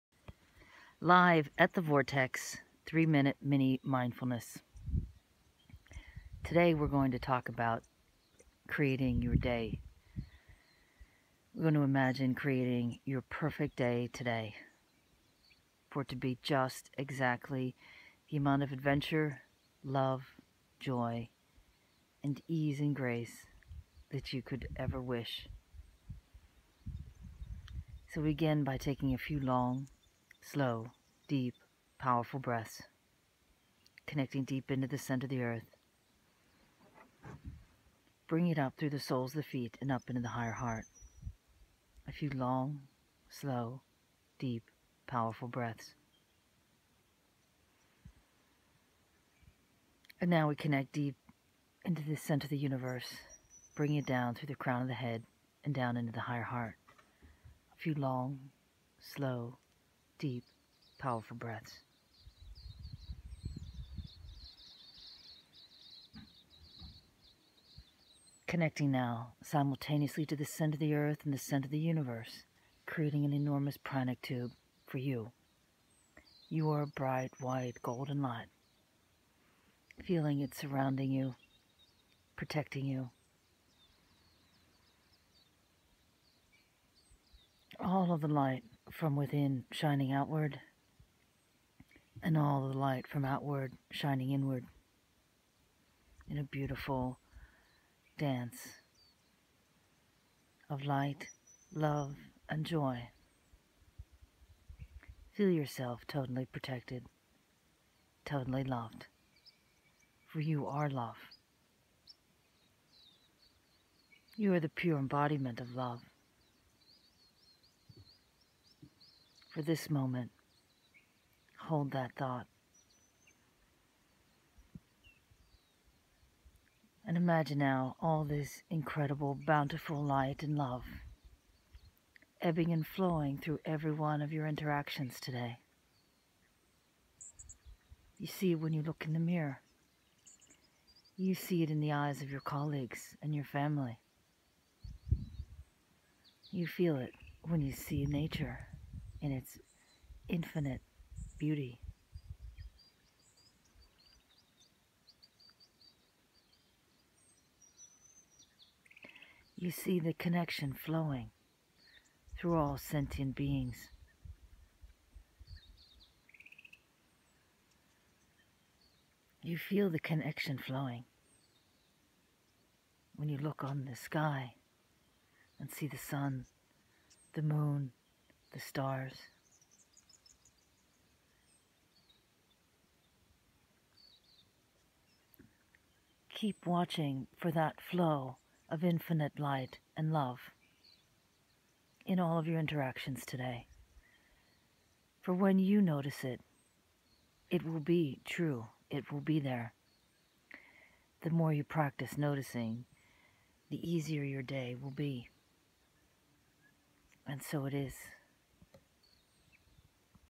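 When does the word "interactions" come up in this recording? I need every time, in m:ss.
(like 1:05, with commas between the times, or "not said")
2:14, 3:12.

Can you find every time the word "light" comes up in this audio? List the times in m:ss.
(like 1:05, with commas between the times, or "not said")
1:18, 1:28, 1:32, 1:40, 2:10, 3:09.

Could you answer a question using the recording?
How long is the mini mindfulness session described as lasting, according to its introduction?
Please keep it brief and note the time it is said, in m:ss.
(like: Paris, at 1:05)
3 minutes, at 0:02.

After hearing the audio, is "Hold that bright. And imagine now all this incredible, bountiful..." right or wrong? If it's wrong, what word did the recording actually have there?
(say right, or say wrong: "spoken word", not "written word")
wrong: "thought", not "bright".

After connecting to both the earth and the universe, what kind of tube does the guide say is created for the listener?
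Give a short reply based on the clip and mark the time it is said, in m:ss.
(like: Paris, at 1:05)
pranic tube, at 1:13.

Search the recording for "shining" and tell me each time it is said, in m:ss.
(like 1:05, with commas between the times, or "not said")
1:29, 1:33.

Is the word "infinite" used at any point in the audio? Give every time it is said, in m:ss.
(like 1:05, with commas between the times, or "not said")
2:30, 3:08.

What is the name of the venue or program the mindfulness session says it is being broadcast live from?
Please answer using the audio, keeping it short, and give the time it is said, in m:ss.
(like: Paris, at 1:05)
the Vortex, at 0:01.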